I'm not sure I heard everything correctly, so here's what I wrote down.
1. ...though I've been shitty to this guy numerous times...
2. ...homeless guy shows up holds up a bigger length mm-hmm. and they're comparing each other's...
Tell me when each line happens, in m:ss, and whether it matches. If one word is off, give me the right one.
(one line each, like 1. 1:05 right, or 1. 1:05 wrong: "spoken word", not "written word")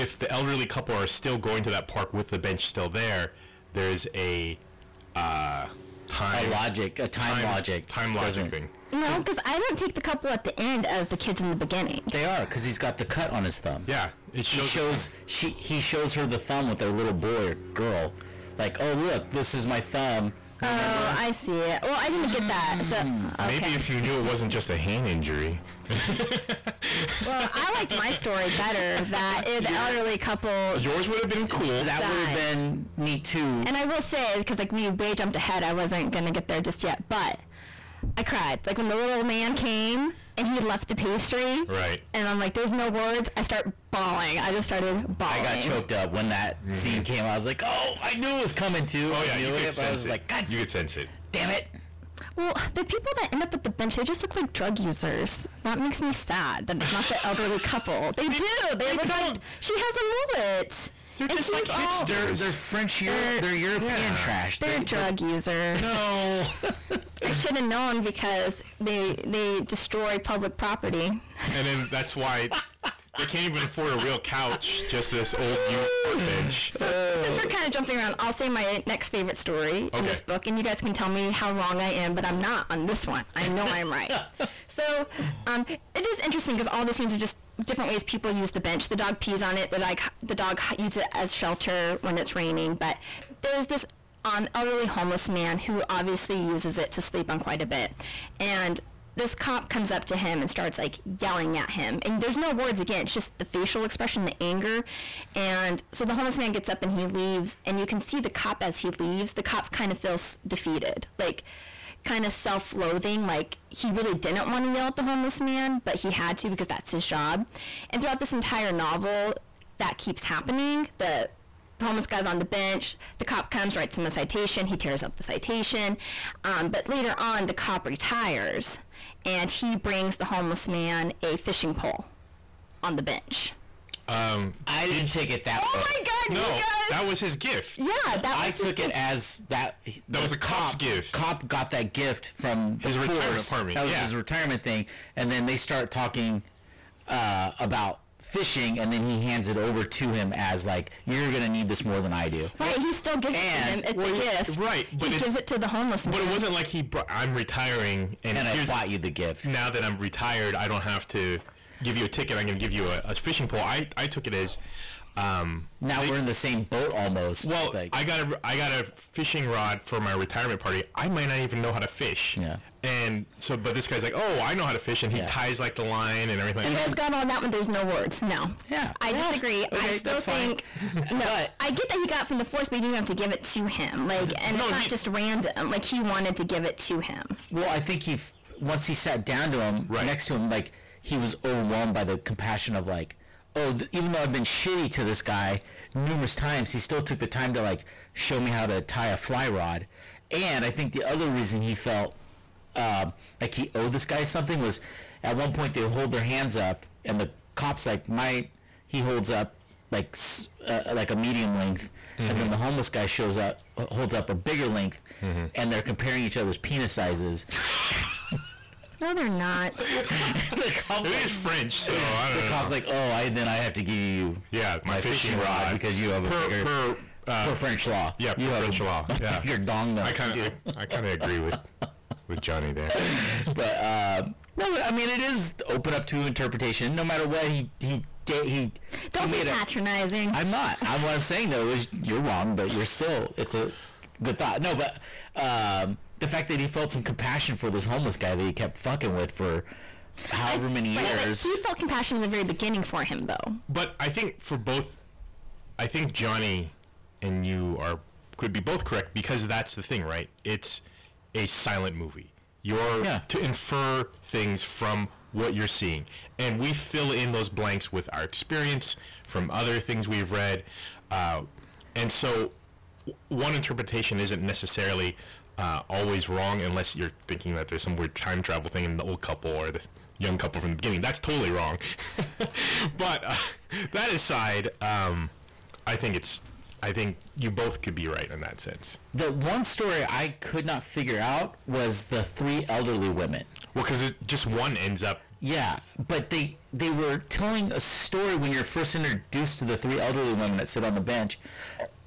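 1. 3:14 right
2. 3:32 right.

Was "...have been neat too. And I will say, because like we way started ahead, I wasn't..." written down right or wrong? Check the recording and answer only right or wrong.
wrong.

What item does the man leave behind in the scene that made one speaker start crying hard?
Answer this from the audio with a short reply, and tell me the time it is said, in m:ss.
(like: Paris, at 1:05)
pastry, at 0:40.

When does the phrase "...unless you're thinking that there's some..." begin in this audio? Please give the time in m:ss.
4:36.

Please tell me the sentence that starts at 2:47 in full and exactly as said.
Well, like, I got a I got a fishing rod for my retirement party.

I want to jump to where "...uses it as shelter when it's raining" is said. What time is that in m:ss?
1:30.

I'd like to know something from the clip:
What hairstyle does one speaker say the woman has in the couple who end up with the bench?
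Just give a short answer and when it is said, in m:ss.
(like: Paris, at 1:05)
mullet, at 1:00.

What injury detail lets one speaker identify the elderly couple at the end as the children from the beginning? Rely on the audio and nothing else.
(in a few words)
cut on his thumb.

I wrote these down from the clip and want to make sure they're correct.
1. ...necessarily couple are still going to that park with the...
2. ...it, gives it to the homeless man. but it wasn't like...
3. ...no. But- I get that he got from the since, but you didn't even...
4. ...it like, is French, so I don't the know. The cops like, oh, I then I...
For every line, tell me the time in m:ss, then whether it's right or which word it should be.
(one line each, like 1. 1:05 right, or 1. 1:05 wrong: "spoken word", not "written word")
1. 0:00 wrong: "elderly", not "necessarily"
2. 2:35 right
3. 3:01 wrong: "force", not "since"
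4. 3:41 right.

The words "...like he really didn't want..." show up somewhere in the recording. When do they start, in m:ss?
1:53.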